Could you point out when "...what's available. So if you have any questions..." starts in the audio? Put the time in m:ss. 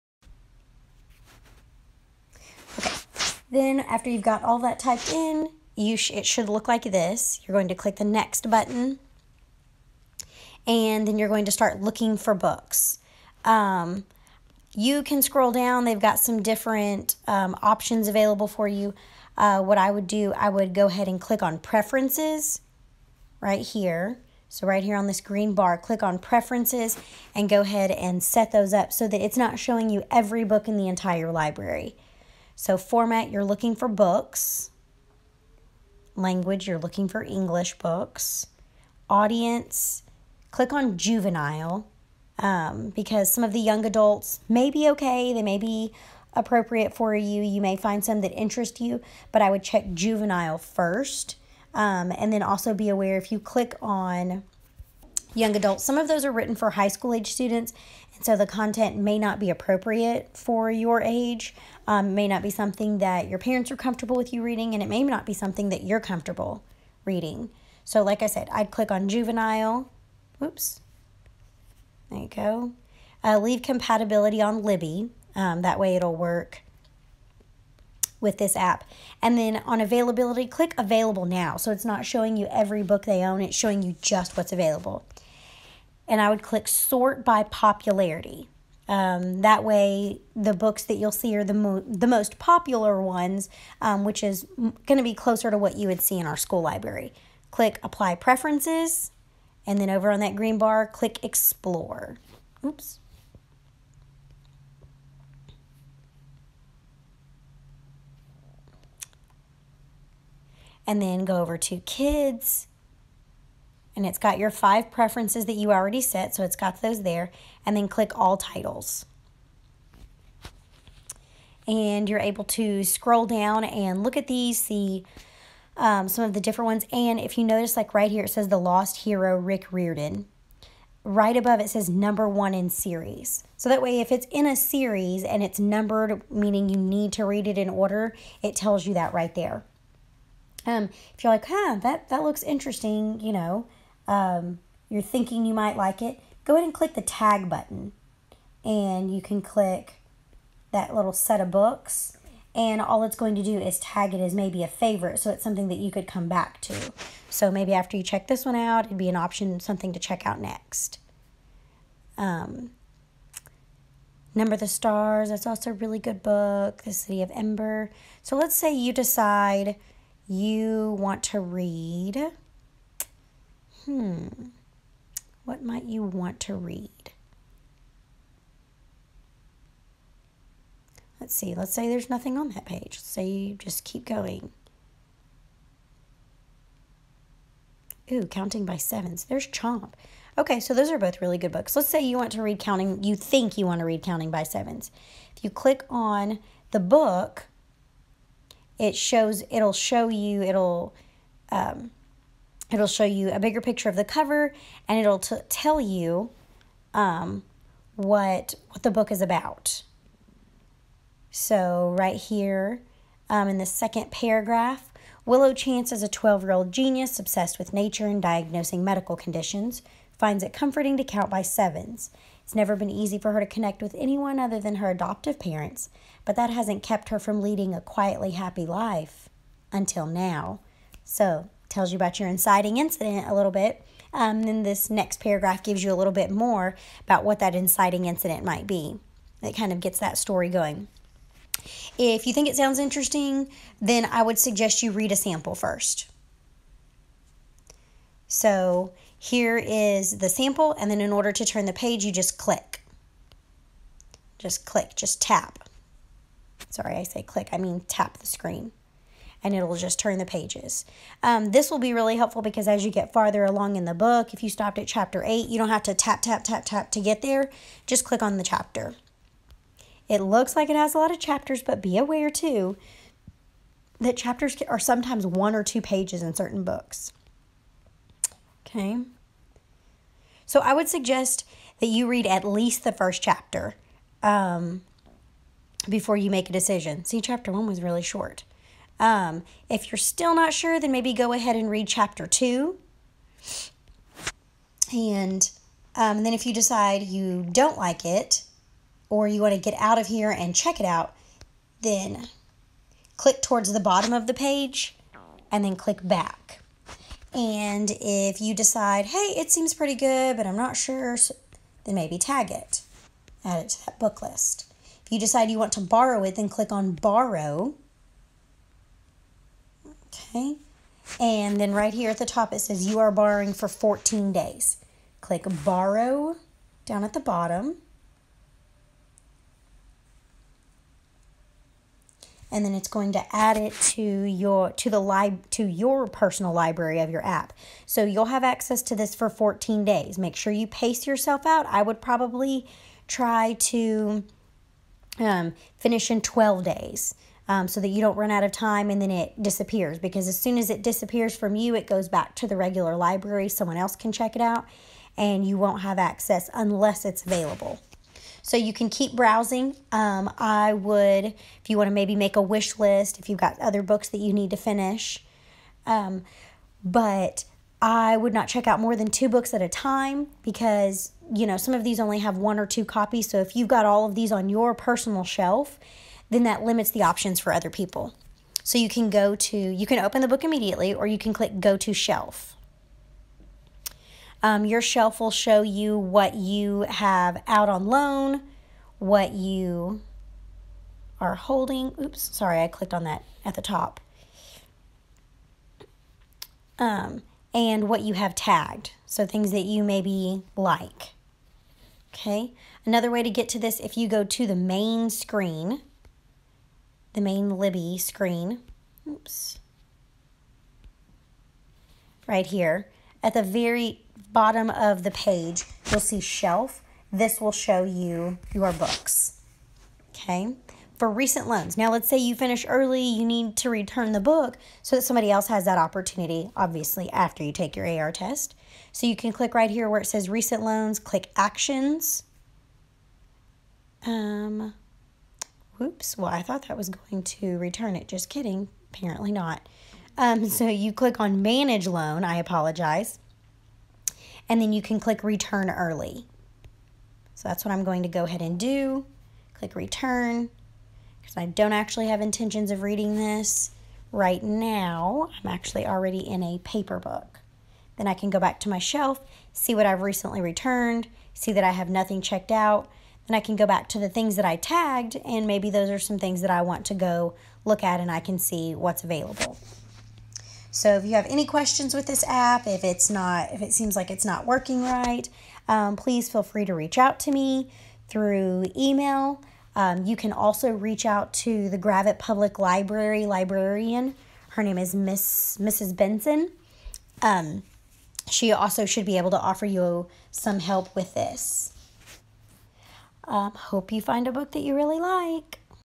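7:48.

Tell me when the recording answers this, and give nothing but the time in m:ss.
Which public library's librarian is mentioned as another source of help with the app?
8:01.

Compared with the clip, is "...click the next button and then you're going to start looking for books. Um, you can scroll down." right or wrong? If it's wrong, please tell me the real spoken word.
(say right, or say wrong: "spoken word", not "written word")
right.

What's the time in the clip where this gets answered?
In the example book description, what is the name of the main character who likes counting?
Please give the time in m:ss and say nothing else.
3:35.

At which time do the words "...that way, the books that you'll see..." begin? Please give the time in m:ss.
1:29.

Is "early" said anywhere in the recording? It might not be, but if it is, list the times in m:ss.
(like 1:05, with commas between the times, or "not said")
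7:02, 7:25.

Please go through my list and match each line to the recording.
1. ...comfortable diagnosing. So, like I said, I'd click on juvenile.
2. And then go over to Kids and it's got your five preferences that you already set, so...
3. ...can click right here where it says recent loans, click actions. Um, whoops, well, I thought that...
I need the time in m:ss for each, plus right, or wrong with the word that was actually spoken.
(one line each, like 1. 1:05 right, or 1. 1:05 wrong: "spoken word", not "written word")
1. 1:05 wrong: "reading", not "diagnosing"
2. 1:50 right
3. 7:09 right.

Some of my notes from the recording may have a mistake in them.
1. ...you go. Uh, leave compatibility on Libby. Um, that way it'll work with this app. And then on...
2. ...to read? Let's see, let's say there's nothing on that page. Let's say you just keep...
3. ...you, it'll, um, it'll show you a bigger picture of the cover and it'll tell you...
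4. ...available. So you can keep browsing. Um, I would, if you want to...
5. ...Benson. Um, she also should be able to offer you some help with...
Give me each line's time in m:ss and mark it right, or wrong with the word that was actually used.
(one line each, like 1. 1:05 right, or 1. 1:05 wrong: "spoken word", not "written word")
1. 1:12 right
2. 2:56 right
3. 3:20 right
4. 5:57 right
5. 8:05 right.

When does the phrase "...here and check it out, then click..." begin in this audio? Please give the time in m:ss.
5:00.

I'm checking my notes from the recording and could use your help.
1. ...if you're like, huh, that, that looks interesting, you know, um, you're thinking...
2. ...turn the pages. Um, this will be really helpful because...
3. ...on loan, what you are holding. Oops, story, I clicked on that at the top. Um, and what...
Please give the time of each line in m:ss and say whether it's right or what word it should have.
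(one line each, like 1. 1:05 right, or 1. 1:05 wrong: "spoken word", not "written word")
1. 2:21 right
2. 4:19 right
3. 6:27 wrong: "sorry", not "story".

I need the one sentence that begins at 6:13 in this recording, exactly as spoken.
So if you've got all of these on your personal shelf, then that limits the options for other people.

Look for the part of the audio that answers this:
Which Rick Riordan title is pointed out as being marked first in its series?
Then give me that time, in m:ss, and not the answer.
2:08.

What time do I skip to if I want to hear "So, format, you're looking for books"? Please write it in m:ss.
0:32.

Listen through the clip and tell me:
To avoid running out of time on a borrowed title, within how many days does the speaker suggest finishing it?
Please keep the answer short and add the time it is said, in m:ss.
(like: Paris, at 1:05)
12, at 5:46.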